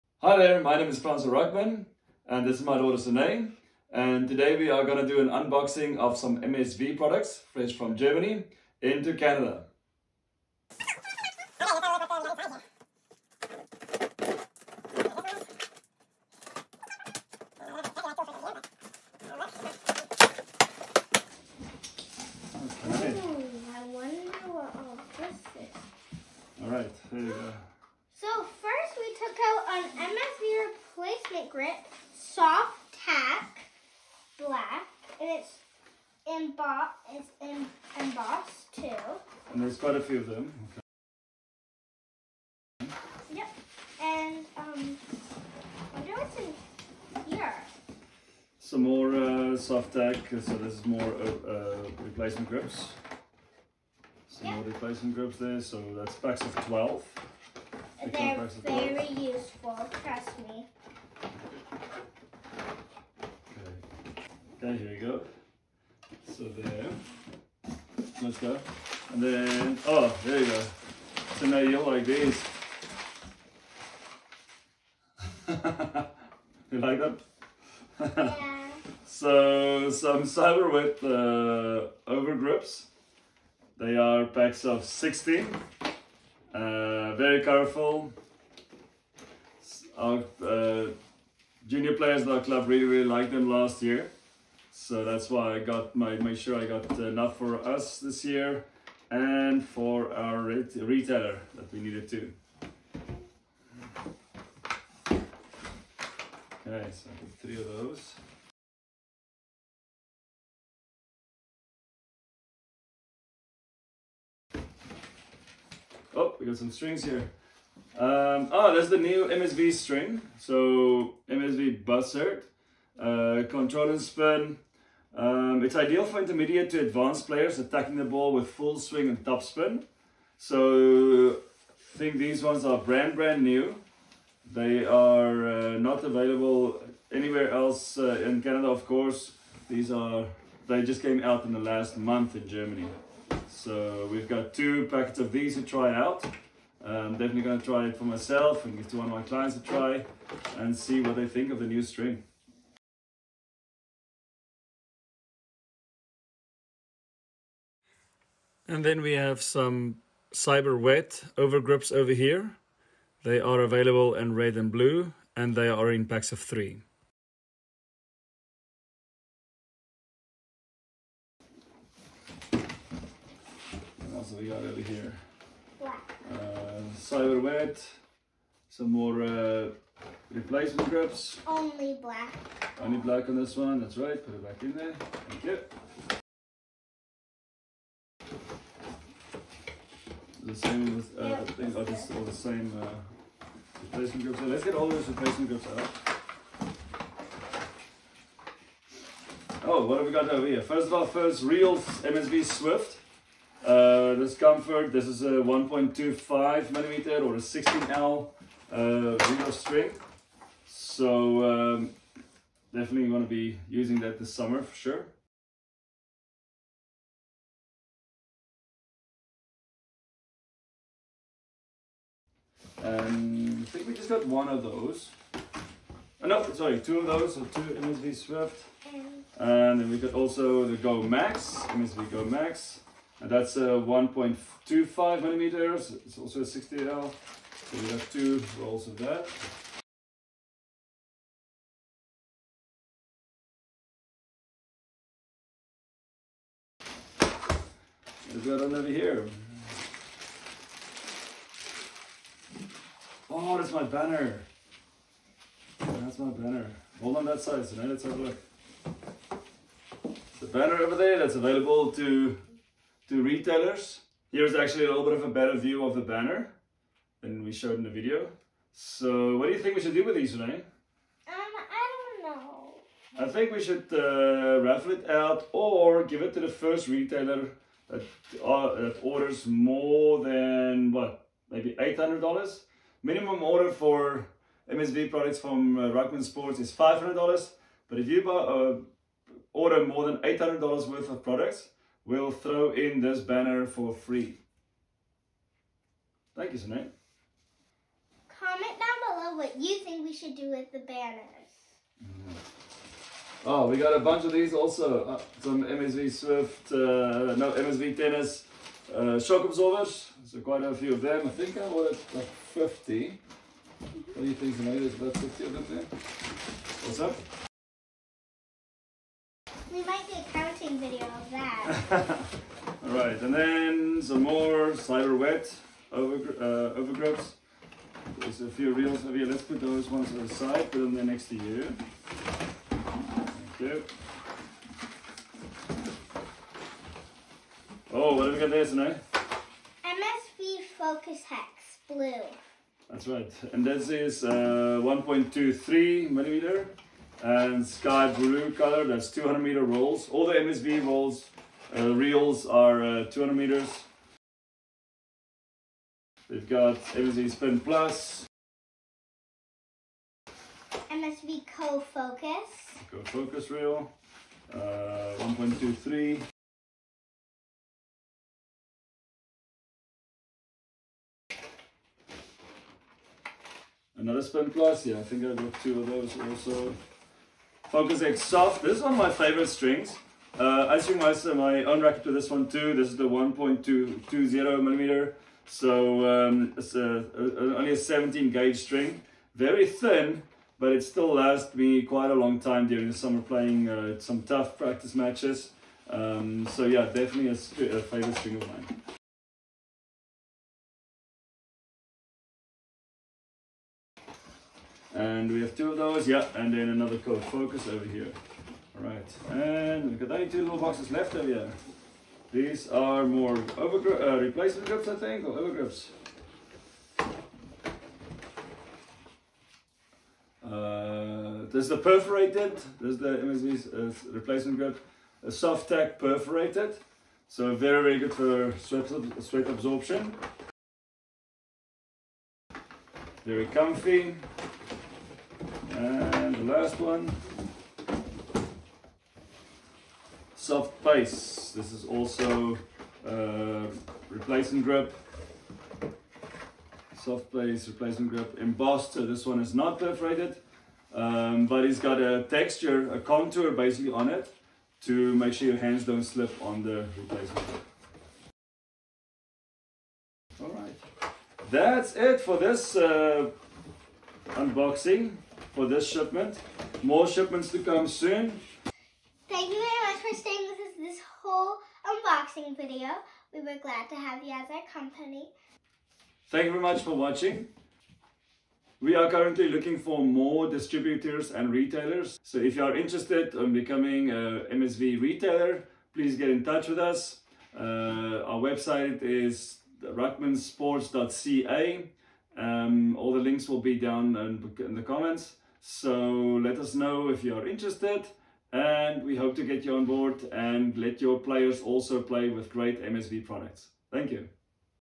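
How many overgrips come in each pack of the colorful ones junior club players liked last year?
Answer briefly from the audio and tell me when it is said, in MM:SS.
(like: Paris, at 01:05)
16, at 01:24.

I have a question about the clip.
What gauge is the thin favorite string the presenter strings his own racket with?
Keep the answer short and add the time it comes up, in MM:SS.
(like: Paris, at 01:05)
17 gauge, at 06:27.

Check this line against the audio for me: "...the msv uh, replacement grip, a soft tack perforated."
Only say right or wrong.
right.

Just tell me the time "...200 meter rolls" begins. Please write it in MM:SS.
05:49.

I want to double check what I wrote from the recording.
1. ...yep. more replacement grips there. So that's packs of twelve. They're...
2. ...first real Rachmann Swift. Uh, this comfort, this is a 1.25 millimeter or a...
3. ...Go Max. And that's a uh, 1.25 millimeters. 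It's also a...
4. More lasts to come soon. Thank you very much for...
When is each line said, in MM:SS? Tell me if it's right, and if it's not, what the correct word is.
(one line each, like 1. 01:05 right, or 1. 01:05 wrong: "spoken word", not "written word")
1. 00:54 right
2. 03:21 wrong: "MSV", not "Rachmann"
3. 03:52 right
4. 07:46 wrong: "shipments", not "lasts".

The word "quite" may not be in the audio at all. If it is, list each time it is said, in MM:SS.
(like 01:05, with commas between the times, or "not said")
00:39, 05:10, 06:31.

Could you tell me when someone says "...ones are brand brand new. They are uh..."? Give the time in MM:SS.
02:12.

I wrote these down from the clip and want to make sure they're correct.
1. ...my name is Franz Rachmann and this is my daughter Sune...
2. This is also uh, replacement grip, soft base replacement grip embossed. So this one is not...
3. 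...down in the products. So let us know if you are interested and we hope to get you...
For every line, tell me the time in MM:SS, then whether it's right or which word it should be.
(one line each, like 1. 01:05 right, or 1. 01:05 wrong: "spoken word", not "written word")
1. 00:00 right
2. 07:21 right
3. 08:13 wrong: "comments", not "products".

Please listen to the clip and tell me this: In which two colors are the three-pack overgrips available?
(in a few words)
red and blue.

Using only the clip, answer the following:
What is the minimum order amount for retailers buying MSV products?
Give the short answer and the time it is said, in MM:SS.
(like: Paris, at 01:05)
$500, at 04:46.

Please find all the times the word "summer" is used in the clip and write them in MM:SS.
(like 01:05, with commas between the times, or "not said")
03:34, 06:32.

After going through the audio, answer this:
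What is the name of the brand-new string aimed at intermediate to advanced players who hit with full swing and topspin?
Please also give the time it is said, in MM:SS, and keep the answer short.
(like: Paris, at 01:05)
MSV Buzzard, at 02:01.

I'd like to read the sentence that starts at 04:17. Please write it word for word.
Hold on that side, so now let's have a look.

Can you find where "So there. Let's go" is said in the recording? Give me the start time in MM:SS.
01:06.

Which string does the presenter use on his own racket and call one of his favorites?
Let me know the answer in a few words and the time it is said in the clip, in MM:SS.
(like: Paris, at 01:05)
Focus Hex Soft, at 06:17.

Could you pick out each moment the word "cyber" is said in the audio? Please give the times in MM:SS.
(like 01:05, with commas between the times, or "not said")
01:20, 02:40, 02:56, 05:24.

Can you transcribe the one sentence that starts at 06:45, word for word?
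And we have two of those, yeah, and then another Co-Focus over here.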